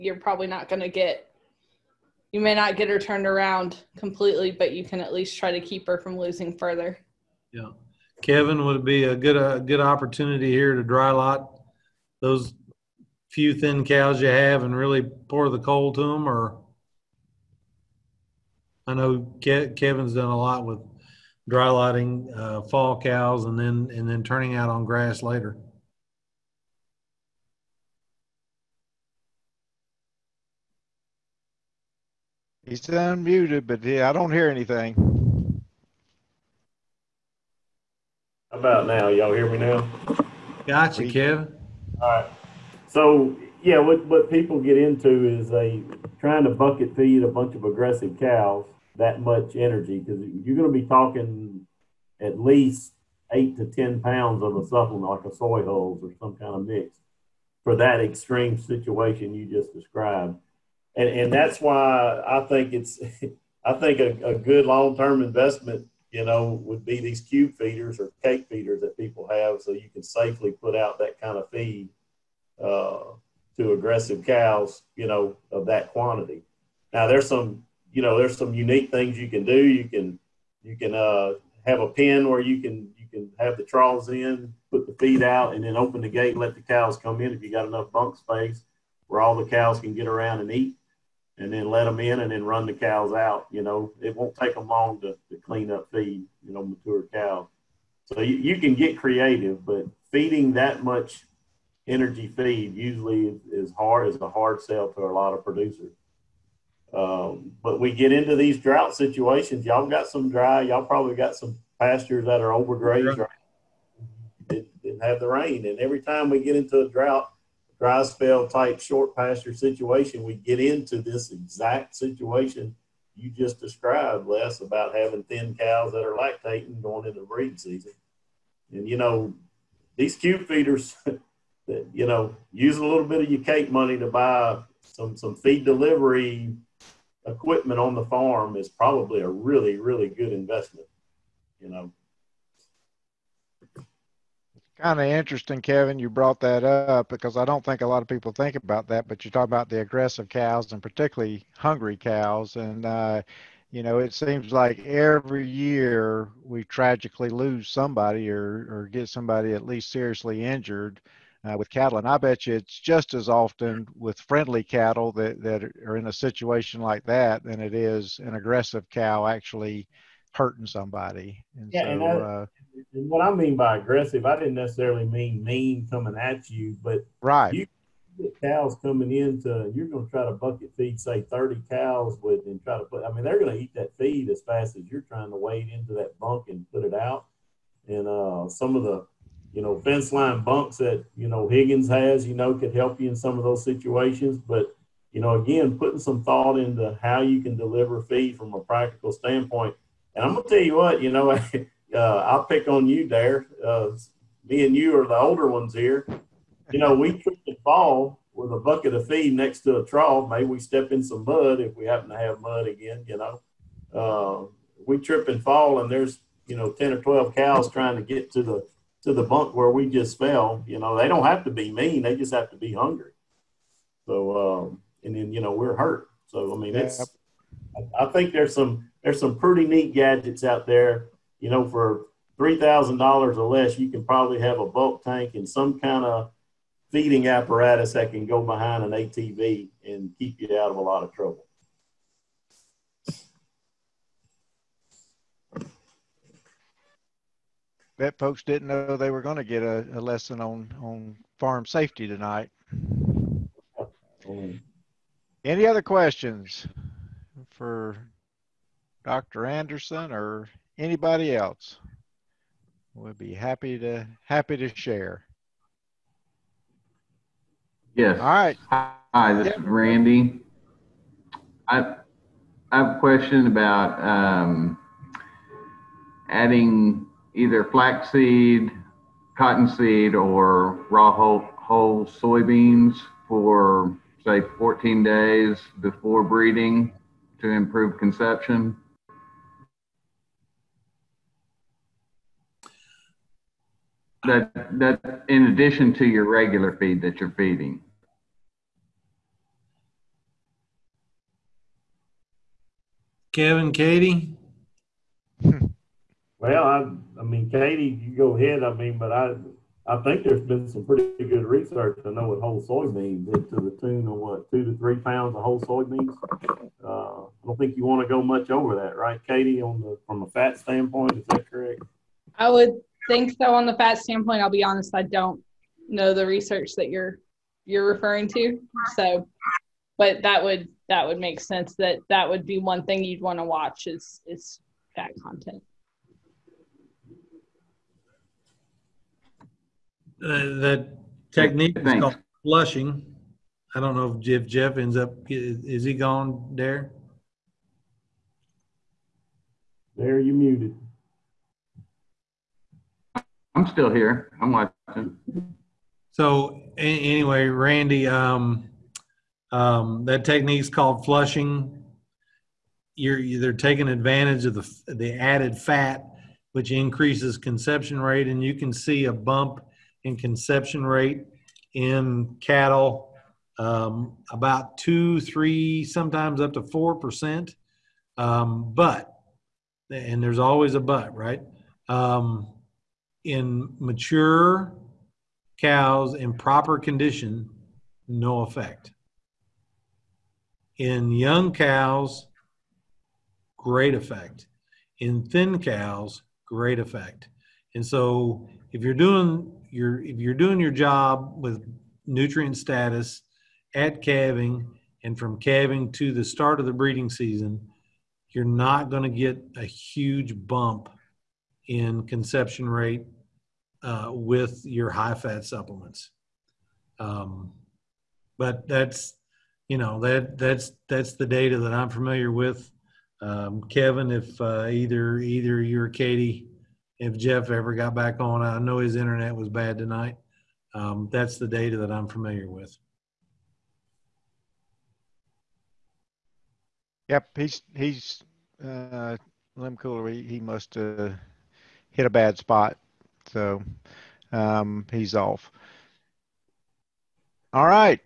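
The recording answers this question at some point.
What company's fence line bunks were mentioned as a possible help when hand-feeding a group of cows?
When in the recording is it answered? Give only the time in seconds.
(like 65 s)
191 s.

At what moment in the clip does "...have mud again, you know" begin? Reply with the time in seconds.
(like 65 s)
212 s.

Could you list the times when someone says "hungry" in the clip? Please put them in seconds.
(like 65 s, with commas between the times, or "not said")
151 s, 222 s.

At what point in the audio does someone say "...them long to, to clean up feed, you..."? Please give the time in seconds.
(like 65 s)
94 s.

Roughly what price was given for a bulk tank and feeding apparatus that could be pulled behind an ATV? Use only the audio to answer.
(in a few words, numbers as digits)
$3,000.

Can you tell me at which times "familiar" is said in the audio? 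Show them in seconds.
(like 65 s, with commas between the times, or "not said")
421 s, 432 s.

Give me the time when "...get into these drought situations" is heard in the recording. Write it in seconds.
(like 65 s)
107 s.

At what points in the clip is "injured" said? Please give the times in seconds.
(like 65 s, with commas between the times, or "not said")
160 s.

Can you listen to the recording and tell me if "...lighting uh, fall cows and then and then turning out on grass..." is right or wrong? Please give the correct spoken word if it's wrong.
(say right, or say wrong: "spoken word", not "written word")
right.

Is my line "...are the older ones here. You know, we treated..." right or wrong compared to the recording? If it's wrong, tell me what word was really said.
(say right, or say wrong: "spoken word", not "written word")
right.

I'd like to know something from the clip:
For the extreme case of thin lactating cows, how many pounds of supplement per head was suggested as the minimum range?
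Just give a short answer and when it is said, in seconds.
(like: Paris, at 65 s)
8 to 10 pounds, at 53 s.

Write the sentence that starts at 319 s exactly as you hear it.
On the from a fat standpoint, is that correct?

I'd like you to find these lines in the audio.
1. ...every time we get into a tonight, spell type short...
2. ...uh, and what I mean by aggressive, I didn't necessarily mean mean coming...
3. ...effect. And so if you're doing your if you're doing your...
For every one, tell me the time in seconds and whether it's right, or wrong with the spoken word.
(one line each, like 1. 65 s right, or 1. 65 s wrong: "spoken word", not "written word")
1. 115 s wrong: "drought", not "tonight"
2. 172 s right
3. 396 s right.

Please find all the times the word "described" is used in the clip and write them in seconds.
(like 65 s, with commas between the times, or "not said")
59 s, 123 s.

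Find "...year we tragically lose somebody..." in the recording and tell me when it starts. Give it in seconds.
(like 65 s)
155 s.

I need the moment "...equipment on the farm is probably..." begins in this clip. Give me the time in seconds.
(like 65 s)
137 s.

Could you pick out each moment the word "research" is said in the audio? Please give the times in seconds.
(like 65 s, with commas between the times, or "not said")
311 s, 326 s.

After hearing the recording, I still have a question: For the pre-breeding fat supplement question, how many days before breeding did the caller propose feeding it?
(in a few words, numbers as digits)
14 days.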